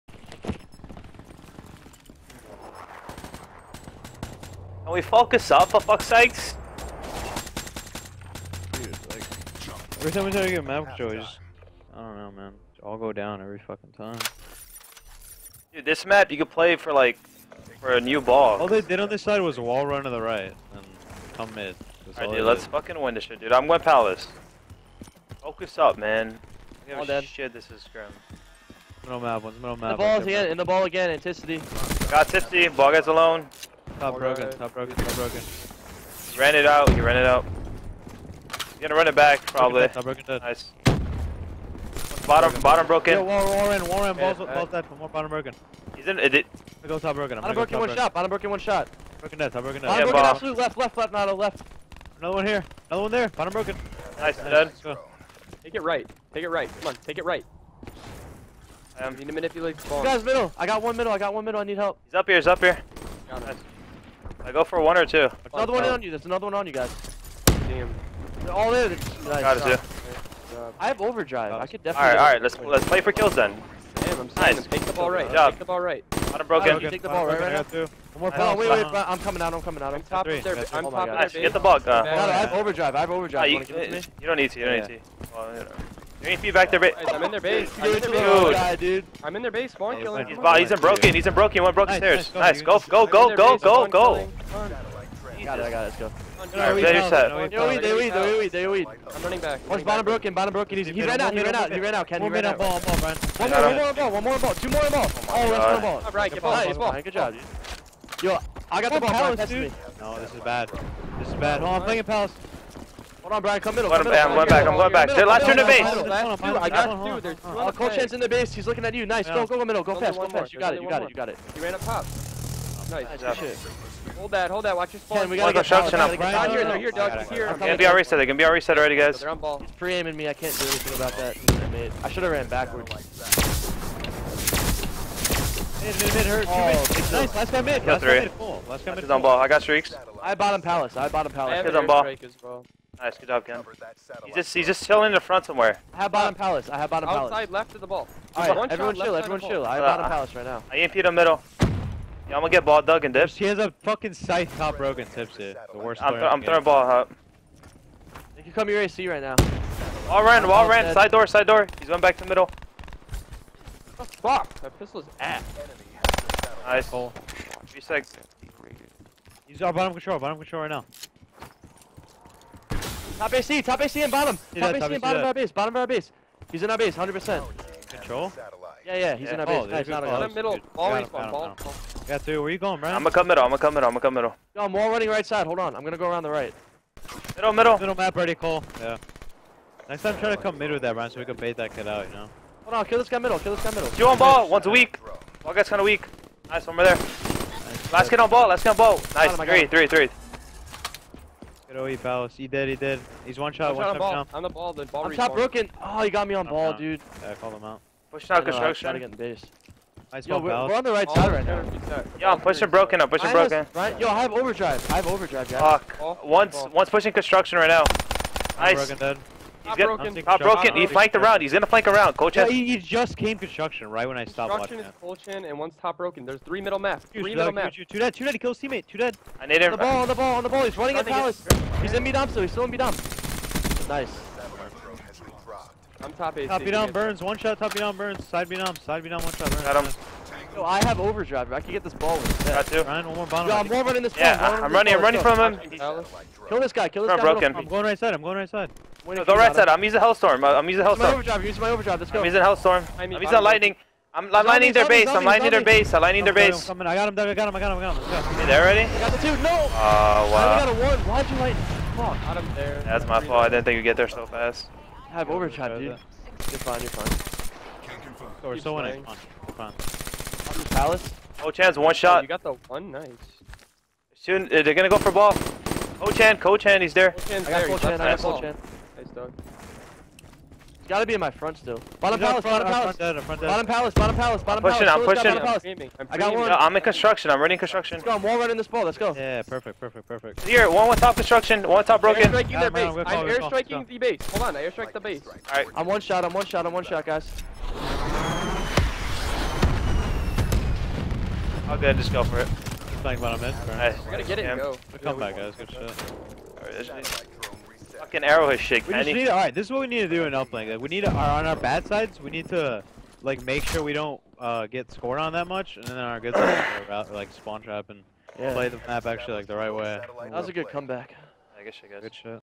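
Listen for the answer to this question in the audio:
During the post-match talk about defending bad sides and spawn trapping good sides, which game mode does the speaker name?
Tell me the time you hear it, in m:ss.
5:10.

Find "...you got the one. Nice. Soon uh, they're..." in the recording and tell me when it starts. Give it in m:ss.
4:32.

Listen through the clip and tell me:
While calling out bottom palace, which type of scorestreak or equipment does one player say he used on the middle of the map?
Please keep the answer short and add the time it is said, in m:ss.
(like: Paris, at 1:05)
EMP, at 2:30.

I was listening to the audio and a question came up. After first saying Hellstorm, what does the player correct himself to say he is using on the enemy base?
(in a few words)
lightning.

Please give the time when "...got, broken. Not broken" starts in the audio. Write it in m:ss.
3:39.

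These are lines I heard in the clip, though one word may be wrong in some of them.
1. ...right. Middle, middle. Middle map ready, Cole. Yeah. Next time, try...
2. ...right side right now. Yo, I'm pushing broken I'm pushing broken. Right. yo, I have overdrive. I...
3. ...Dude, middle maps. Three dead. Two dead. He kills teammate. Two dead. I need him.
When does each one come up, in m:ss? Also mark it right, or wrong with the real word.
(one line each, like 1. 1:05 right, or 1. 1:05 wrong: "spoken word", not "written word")
1. 3:06 right
2. 3:30 right
3. 3:47 wrong: "Two", not "Three".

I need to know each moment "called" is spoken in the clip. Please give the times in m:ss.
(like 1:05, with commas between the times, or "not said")
3:27.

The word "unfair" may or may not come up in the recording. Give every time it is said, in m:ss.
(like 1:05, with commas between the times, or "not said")
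not said.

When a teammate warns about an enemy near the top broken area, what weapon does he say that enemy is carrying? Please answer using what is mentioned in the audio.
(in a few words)
scythe.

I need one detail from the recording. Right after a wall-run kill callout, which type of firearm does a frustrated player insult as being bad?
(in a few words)
pistol.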